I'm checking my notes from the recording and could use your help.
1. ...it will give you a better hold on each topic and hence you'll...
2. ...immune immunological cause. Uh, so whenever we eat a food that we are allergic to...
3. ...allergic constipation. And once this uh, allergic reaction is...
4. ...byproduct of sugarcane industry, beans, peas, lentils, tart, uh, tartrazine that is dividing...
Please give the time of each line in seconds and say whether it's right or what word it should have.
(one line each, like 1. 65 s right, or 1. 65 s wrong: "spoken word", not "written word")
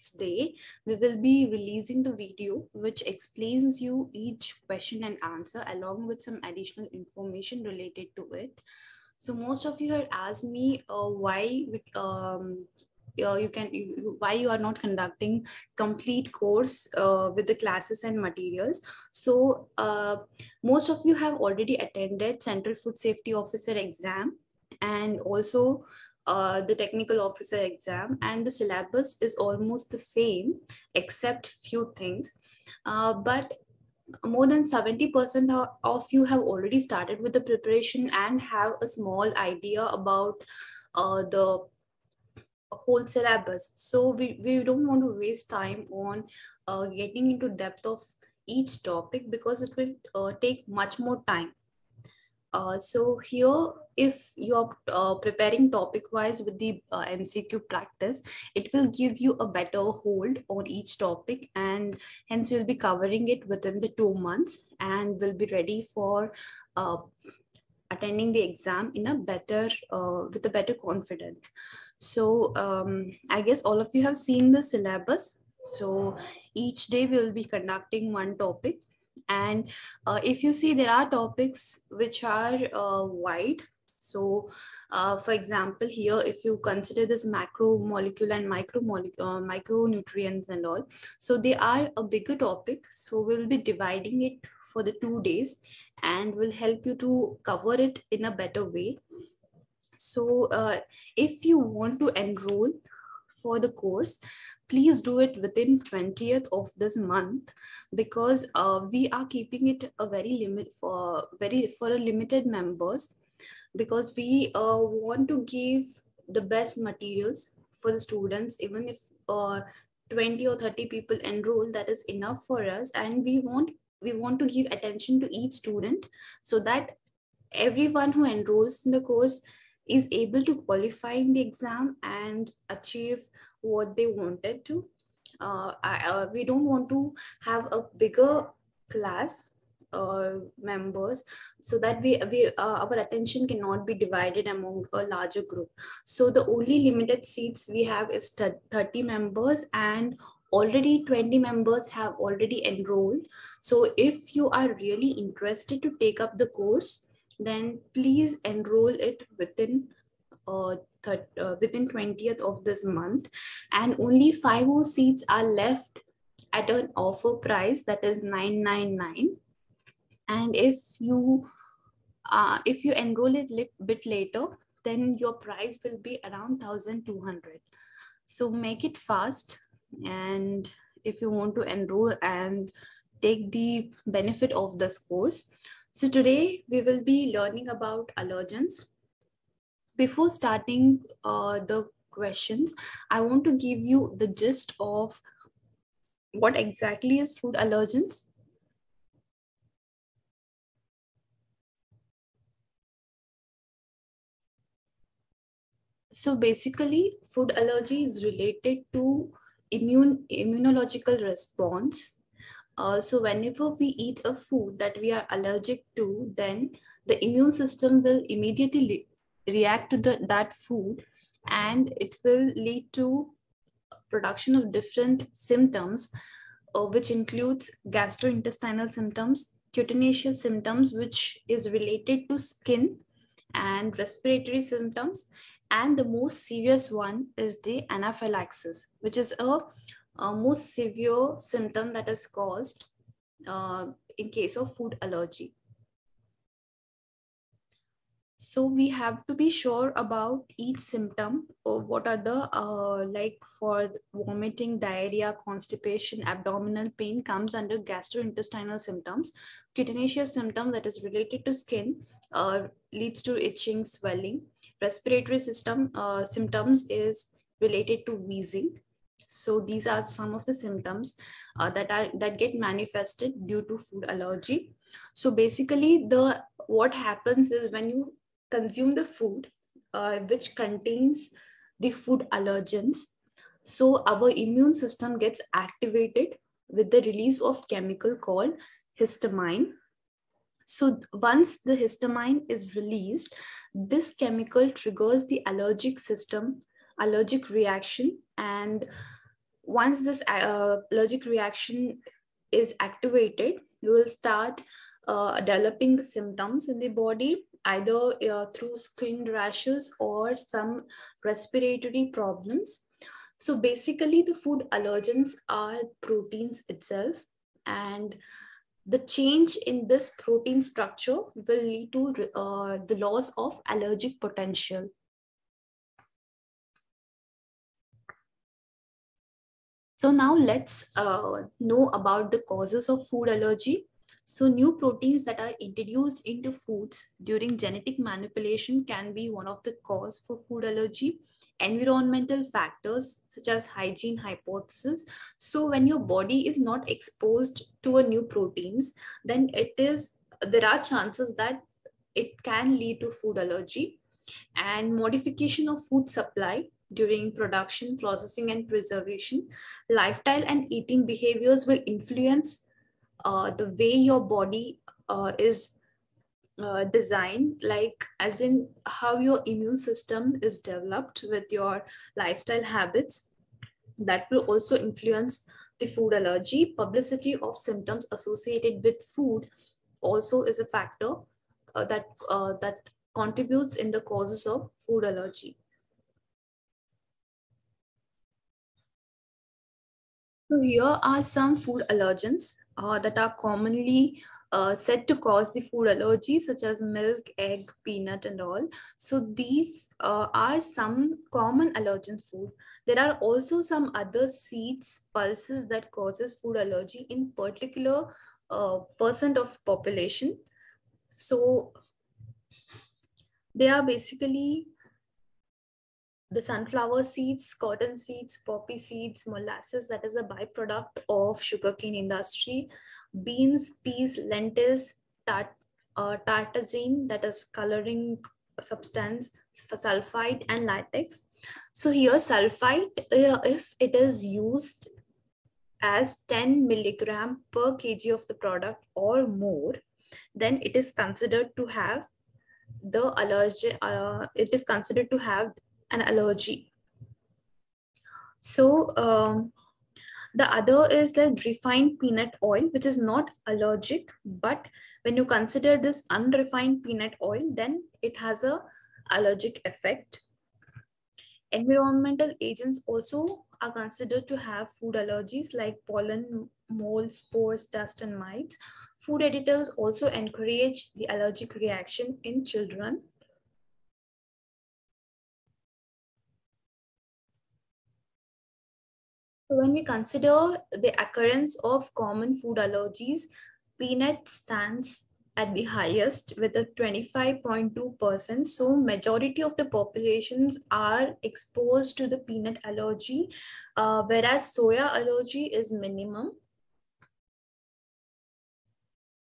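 1. 58 s right
2. 209 s wrong: "response", not "cause"
3. 296 s wrong: "reaction", not "constipation"
4. 420 s wrong: "coloring", not "dividing".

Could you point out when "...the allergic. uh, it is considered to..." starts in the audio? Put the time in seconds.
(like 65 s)
442 s.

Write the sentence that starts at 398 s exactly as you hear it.
So these uh, are some common allergen food.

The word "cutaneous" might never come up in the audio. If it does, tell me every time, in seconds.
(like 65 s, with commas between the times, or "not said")
229 s, 259 s.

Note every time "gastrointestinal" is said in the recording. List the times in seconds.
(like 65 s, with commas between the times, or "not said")
227 s, 257 s.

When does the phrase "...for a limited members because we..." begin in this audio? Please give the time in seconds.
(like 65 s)
111 s.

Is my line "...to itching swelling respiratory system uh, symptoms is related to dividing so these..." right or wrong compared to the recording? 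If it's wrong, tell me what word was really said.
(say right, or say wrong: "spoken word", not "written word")
wrong: "wheezing", not "dividing".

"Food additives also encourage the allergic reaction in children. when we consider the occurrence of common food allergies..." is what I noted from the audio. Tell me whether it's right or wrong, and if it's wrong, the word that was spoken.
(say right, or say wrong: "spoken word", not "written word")
right.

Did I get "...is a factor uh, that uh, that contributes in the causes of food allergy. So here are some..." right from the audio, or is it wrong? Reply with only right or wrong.
right.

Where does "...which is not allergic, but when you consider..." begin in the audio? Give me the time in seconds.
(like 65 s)
452 s.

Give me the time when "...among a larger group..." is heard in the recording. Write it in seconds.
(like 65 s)
144 s.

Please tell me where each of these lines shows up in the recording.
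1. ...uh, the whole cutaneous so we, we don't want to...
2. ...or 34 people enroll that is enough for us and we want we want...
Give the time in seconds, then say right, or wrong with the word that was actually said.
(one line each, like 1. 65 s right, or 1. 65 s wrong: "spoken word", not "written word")
1. 40 s wrong: "syllabus", not "cutaneous"
2. 120 s wrong: "30", not "34".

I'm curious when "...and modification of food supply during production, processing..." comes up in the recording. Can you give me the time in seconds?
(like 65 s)
354 s.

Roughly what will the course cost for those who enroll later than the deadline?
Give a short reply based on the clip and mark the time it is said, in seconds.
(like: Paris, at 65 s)
1200, at 176 s.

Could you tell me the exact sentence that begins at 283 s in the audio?
So our immune system gets activated with the release of chemical called histamine.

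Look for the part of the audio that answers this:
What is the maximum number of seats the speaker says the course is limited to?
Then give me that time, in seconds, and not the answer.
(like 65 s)
148 s.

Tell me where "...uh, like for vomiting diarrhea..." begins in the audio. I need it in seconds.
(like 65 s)
252 s.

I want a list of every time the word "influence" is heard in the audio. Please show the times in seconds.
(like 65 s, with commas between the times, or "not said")
361 s, 374 s.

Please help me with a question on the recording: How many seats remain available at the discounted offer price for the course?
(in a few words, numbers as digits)
5.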